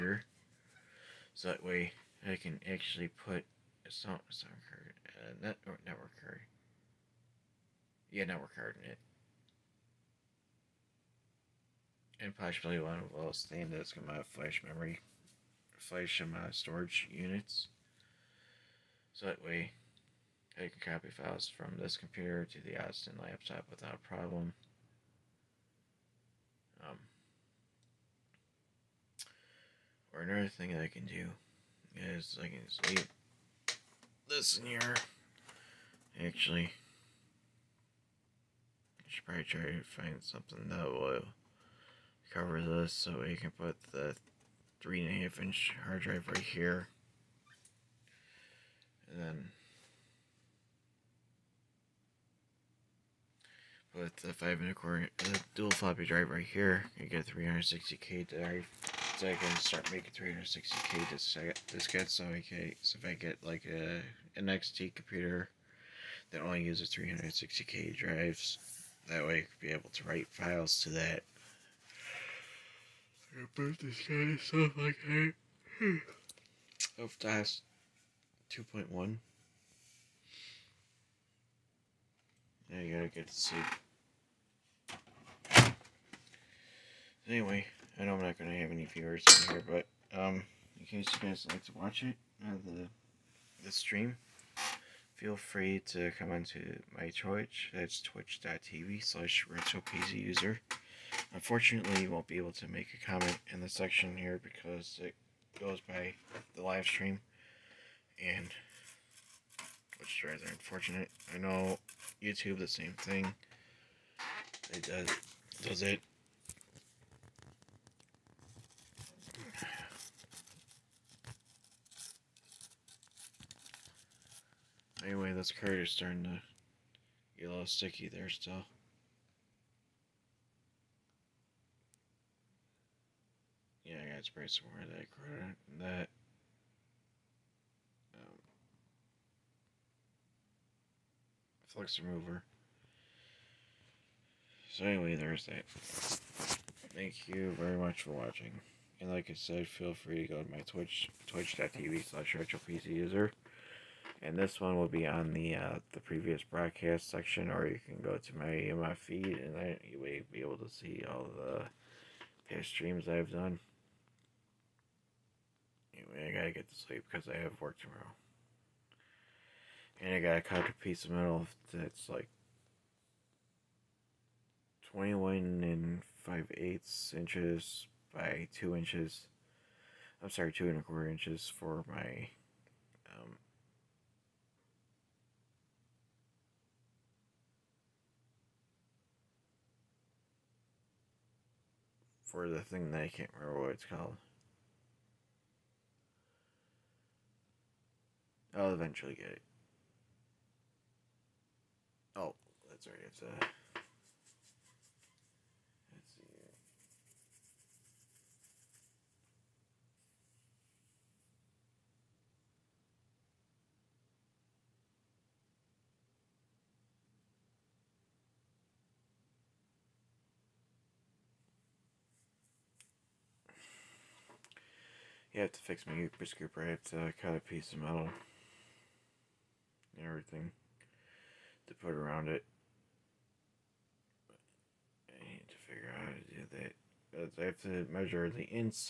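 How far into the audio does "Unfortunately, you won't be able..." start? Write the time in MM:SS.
01:41.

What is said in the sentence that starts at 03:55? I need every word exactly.
I need to figure out how to do that.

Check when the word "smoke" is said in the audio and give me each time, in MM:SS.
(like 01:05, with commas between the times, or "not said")
not said.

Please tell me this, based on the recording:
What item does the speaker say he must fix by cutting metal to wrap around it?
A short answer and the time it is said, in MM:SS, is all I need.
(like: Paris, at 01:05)
Ooper Scooper, at 03:45.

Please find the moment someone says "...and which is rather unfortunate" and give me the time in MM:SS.
01:48.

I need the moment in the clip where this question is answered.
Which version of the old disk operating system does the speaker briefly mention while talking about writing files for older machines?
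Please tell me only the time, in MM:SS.
01:17.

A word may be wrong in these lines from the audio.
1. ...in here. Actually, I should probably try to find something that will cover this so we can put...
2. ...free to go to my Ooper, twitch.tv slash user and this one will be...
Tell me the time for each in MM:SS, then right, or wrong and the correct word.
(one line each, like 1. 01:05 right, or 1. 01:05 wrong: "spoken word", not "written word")
1. 00:34 right
2. 02:29 wrong: "Twitch", not "Ooper".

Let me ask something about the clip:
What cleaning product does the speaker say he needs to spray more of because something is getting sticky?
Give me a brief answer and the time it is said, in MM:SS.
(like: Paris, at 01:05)
flux remover, at 02:21.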